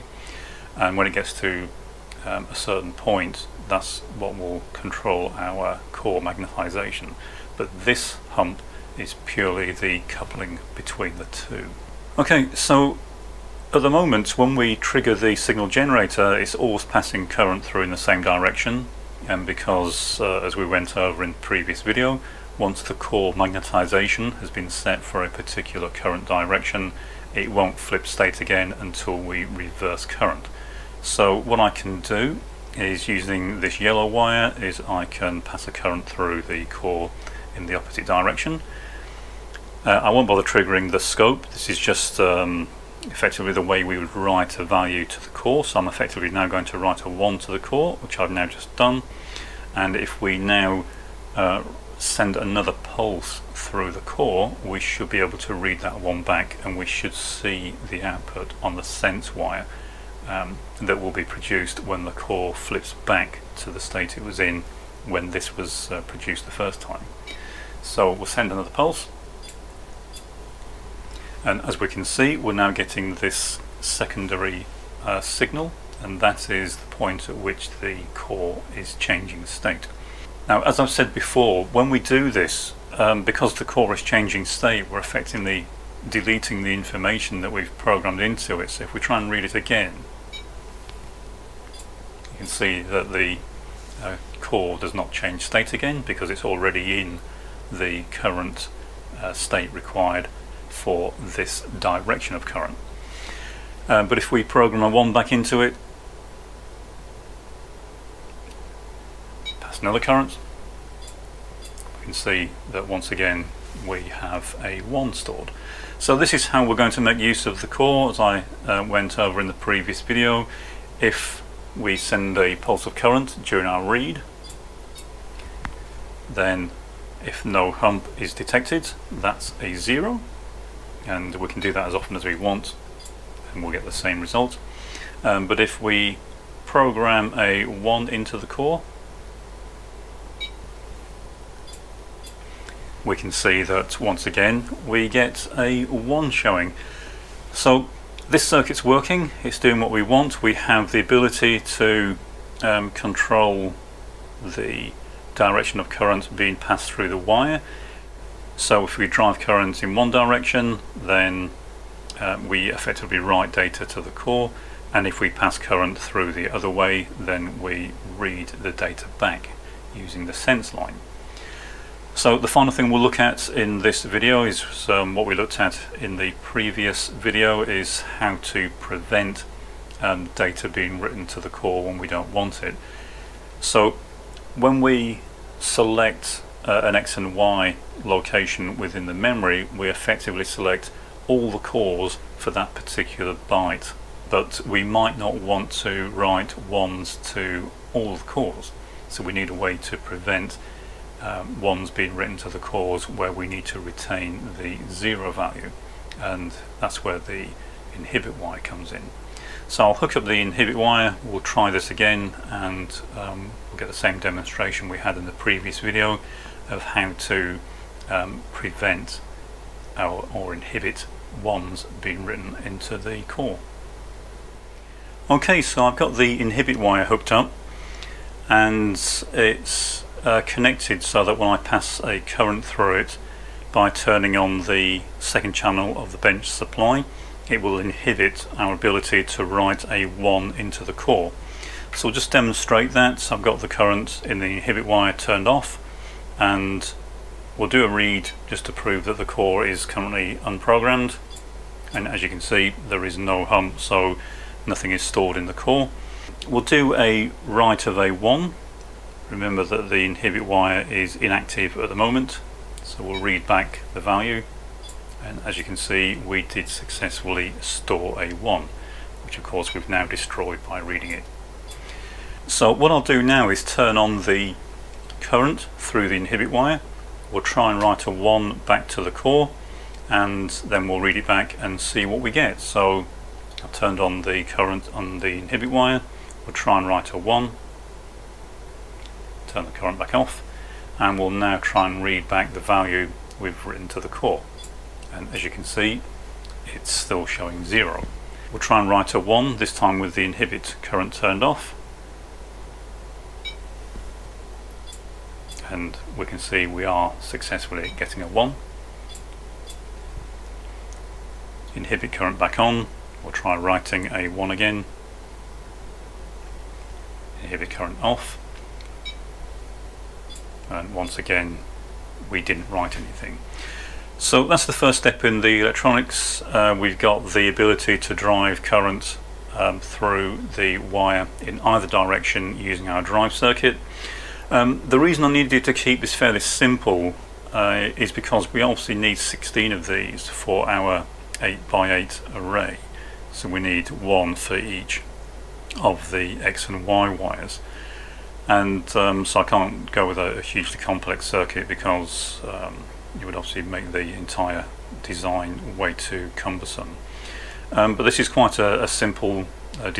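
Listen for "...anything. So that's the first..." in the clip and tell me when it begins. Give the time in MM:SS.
05:22.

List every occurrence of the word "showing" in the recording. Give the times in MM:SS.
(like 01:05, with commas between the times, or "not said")
02:26, 04:57.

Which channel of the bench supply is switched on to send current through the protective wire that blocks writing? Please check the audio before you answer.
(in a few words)
The second channel.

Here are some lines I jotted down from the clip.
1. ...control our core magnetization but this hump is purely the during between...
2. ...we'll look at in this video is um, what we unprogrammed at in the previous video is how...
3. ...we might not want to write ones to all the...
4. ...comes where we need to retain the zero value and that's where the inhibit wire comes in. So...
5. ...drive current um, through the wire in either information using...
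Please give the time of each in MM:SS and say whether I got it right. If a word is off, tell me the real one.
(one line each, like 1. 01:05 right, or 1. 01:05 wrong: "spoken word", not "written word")
1. 00:04 wrong: "coupling", not "during"
2. 02:52 wrong: "looked", not "unprogrammed"
3. 03:14 right
4. 03:22 wrong: "cores", not "comes"
5. 05:28 wrong: "direction", not "information".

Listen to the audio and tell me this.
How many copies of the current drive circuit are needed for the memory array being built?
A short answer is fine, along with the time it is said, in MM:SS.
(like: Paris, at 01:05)
16, at 05:39.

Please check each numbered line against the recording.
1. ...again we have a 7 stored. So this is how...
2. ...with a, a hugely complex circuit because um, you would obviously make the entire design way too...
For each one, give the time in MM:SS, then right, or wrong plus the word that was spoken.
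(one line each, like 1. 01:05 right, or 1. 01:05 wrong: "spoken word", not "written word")
1. 01:53 wrong: "1", not "7"
2. 05:50 right.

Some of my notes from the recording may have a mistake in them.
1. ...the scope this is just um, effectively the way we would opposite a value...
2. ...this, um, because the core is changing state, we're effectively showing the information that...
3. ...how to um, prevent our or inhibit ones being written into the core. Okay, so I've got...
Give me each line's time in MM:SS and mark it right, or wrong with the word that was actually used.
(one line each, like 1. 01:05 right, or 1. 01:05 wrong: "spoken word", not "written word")
1. 00:40 wrong: "write", not "opposite"
2. 01:22 wrong: "deleting", not "showing"
3. 03:36 right.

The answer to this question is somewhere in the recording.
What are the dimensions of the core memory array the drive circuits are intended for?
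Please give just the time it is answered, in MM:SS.
05:41.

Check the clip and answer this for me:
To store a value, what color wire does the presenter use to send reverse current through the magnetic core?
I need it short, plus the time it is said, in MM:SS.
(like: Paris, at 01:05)
Yellow, at 00:33.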